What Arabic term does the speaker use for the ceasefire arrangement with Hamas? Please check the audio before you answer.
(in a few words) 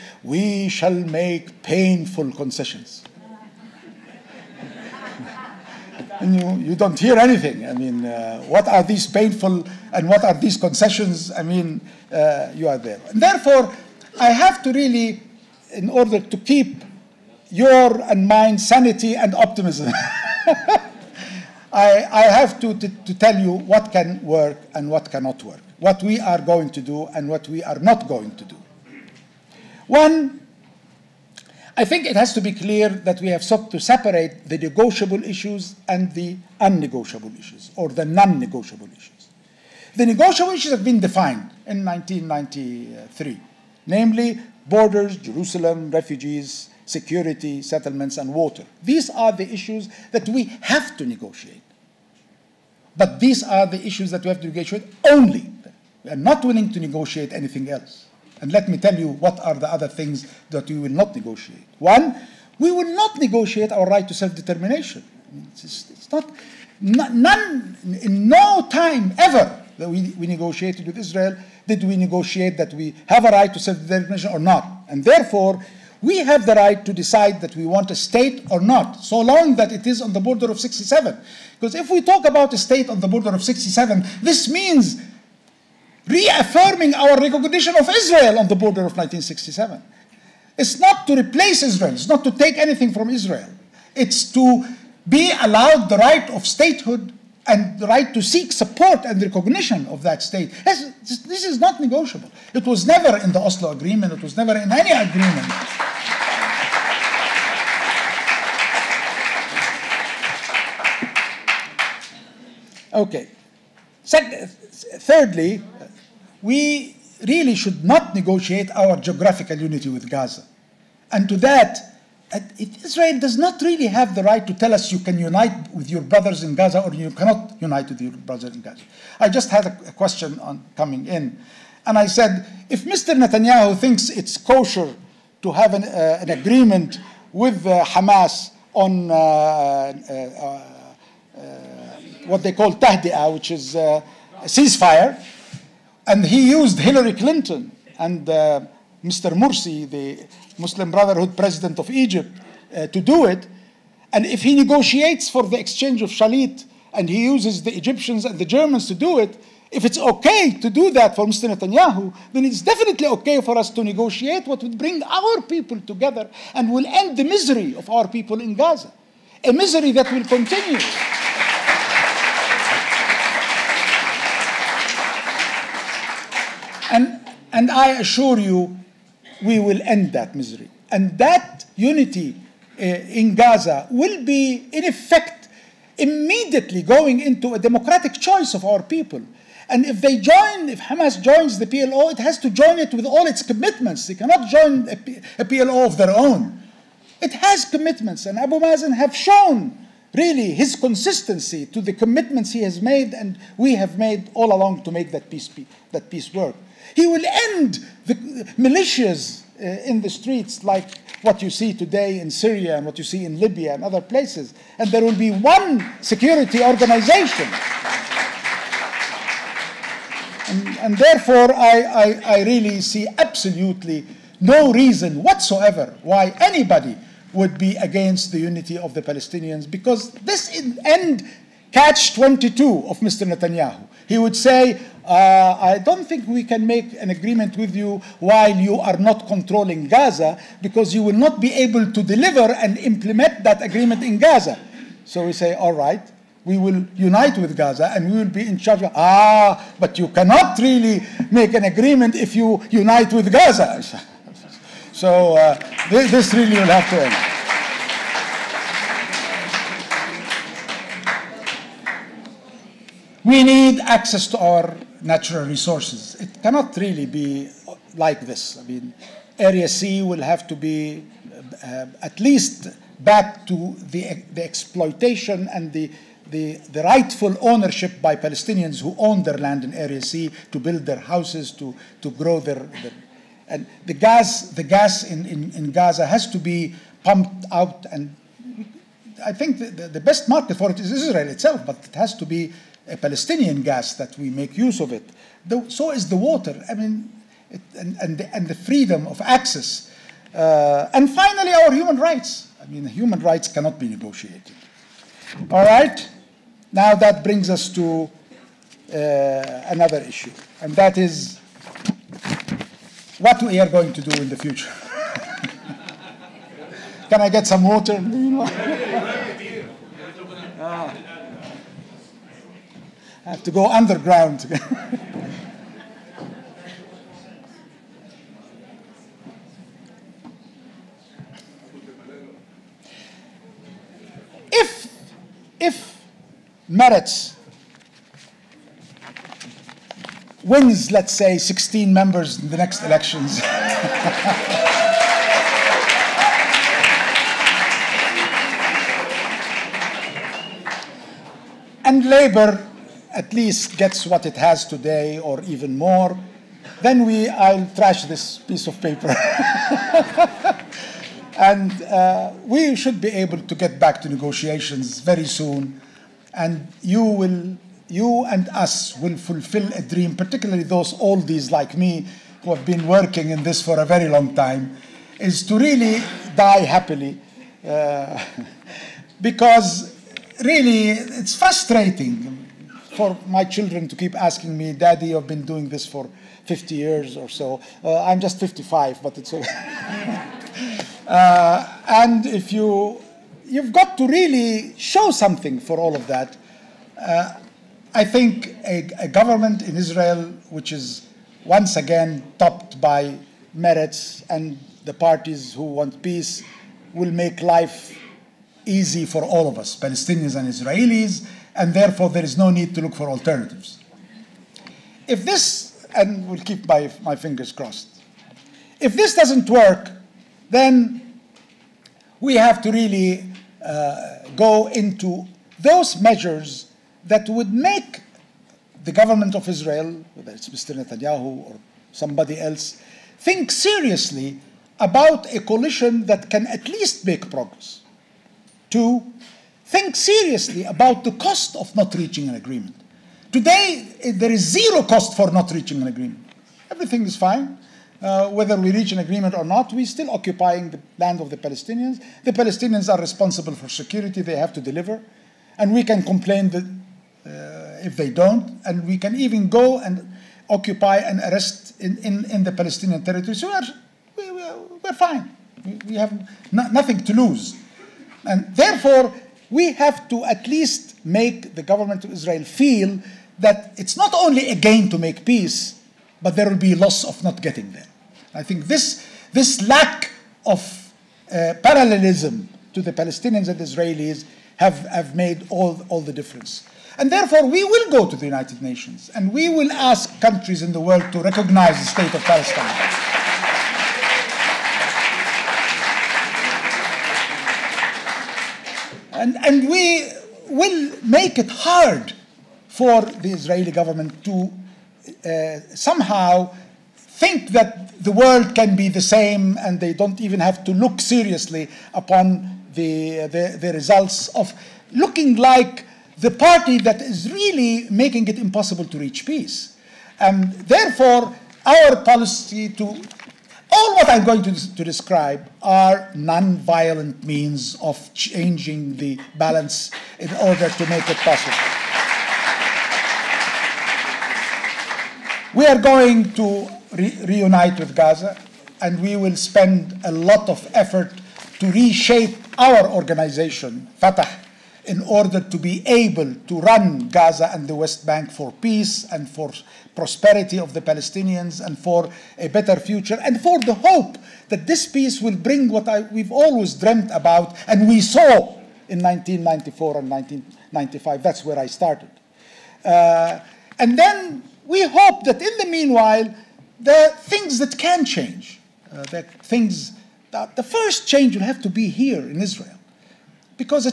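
tahdi'ah.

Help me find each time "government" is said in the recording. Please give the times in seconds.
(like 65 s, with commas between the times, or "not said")
399 s, 428 s, 471 s, 503 s.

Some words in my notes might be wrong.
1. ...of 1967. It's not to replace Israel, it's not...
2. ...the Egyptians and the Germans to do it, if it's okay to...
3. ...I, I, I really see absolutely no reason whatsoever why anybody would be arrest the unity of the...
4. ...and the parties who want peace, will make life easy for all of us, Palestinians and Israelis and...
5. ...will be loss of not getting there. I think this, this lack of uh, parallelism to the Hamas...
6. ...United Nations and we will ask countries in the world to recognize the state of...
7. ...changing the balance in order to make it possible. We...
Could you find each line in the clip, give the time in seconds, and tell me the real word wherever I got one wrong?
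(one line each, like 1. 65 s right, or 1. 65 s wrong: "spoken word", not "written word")
1. 88 s right
2. 157 s right
3. 221 s wrong: "against", not "arrest"
4. 404 s right
5. 476 s wrong: "Palestinians", not "Hamas"
6. 488 s right
7. 528 s right.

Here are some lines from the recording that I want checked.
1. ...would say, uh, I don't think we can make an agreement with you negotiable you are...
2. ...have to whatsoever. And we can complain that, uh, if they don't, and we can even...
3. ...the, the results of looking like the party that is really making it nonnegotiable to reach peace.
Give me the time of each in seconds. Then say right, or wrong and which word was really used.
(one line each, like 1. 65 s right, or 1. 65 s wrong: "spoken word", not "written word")
1. 234 s wrong: "while", not "negotiable"
2. 454 s wrong: "deliver", not "whatsoever"
3. 513 s wrong: "impossible", not "nonnegotiable".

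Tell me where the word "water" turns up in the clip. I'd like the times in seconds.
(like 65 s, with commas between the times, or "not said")
48 s, 296 s, 317 s.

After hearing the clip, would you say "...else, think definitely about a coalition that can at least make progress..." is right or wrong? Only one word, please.
wrong.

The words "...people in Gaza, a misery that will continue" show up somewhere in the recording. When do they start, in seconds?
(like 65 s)
168 s.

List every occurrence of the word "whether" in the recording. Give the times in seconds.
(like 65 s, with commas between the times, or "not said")
430 s, 448 s.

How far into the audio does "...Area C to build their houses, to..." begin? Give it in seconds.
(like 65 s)
279 s.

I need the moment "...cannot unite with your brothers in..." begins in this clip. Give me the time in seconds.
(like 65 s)
127 s.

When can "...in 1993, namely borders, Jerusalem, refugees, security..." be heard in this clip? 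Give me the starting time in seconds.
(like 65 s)
41 s.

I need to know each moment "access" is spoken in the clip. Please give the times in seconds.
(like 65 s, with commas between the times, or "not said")
263 s, 299 s.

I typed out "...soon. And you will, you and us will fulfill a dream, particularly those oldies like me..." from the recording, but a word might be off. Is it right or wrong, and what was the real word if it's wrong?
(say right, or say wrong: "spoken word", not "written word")
right.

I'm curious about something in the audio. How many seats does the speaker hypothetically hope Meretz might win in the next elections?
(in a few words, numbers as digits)
16.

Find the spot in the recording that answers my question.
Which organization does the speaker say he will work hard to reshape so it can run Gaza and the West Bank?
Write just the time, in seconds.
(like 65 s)
543 s.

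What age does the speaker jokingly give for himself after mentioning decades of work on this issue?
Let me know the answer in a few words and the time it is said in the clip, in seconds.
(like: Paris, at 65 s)
55, at 388 s.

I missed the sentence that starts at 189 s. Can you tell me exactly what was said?
And if they join, if Hamas joins the PLO, it has to join it with all its commitments.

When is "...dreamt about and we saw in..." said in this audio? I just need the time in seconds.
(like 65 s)
556 s.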